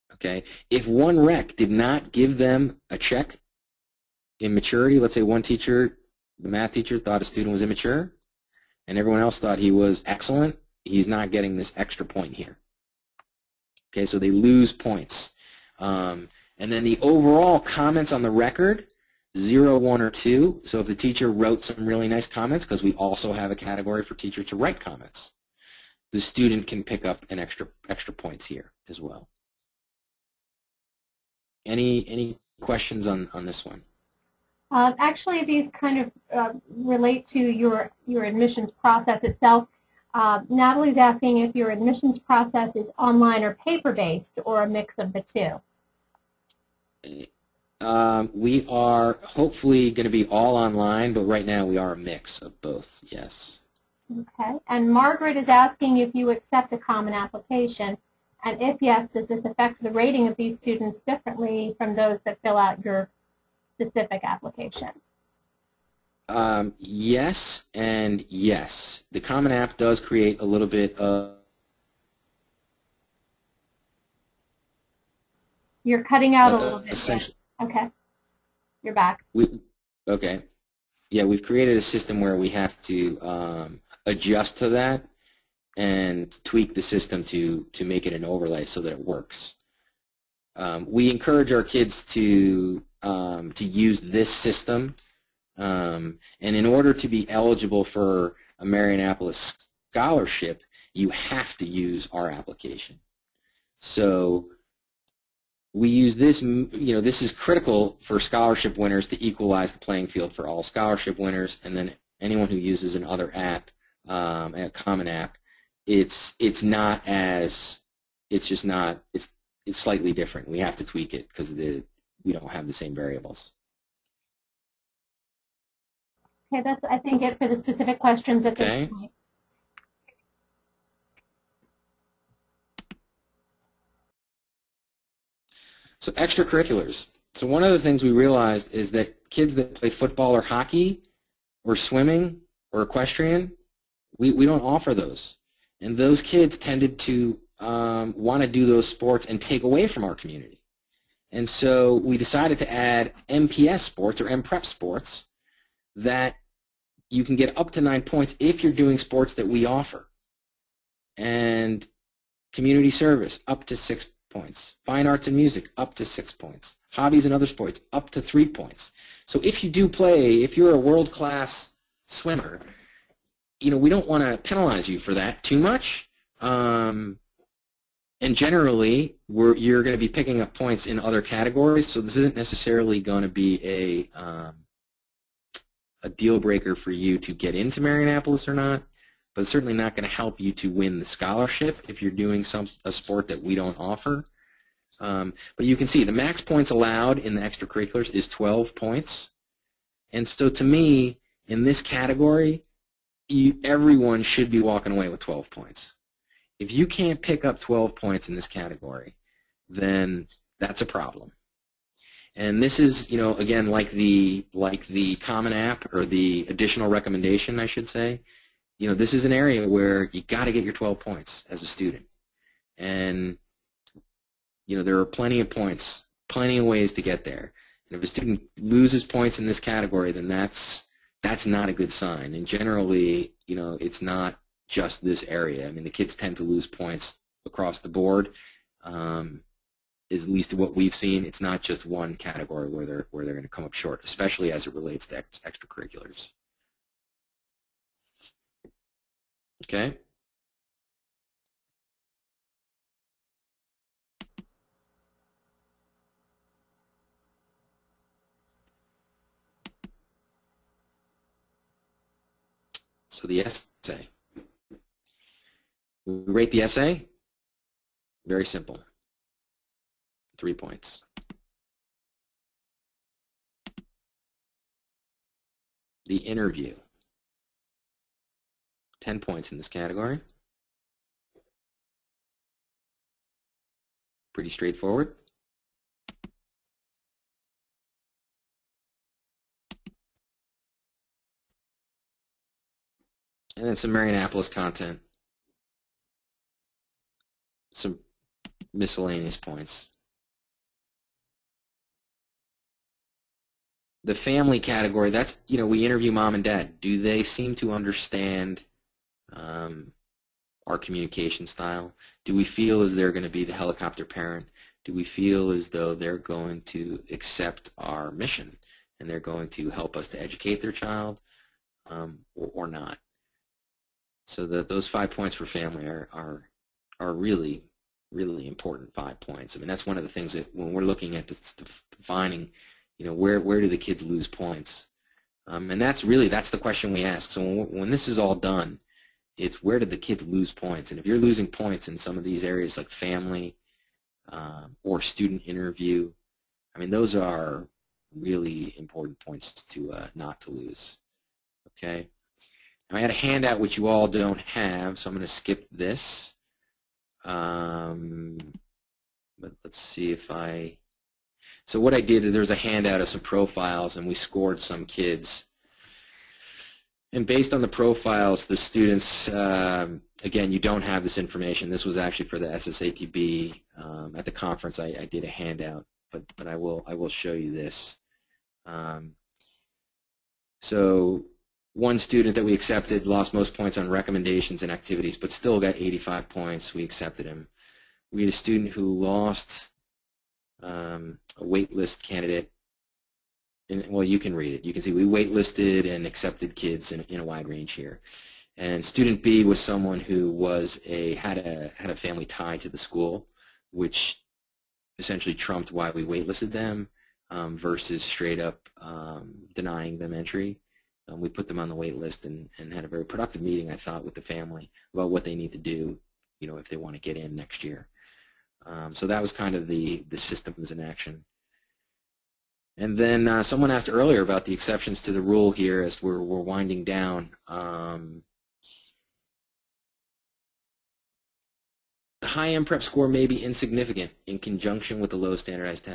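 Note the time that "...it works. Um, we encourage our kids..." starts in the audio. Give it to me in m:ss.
1:28.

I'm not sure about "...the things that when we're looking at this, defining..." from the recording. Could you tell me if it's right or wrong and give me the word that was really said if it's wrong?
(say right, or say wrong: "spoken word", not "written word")
right.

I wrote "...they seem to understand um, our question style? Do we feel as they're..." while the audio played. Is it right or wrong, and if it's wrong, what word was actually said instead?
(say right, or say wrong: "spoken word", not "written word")
wrong: "communication", not "question".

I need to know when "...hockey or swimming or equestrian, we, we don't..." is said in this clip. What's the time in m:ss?
2:20.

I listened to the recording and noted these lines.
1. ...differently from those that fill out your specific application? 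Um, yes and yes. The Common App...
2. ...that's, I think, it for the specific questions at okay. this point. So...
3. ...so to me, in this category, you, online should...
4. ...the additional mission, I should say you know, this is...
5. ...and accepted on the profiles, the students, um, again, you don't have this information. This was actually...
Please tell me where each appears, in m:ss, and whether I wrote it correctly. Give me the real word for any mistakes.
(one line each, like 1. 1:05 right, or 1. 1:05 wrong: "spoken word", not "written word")
1. 1:01 right
2. 2:06 right
3. 3:20 wrong: "everyone", not "online"
4. 3:36 wrong: "recommendation", not "mission"
5. 6:07 wrong: "based", not "accepted".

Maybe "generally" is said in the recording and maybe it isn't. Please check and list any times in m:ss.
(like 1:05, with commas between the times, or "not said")
2:58, 3:52.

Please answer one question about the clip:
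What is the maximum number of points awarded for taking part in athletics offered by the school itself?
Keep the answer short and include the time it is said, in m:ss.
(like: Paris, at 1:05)
9, at 2:37.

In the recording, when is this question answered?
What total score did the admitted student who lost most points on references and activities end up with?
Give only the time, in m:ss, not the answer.
6:25.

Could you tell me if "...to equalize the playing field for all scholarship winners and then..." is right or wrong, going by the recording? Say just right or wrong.
right.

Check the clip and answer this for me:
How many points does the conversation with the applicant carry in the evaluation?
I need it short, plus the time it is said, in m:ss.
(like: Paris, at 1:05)
10, at 4:39.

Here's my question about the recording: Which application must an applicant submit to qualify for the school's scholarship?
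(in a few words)
Our application.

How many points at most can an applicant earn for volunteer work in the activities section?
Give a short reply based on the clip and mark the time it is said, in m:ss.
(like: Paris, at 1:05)
6, at 2:42.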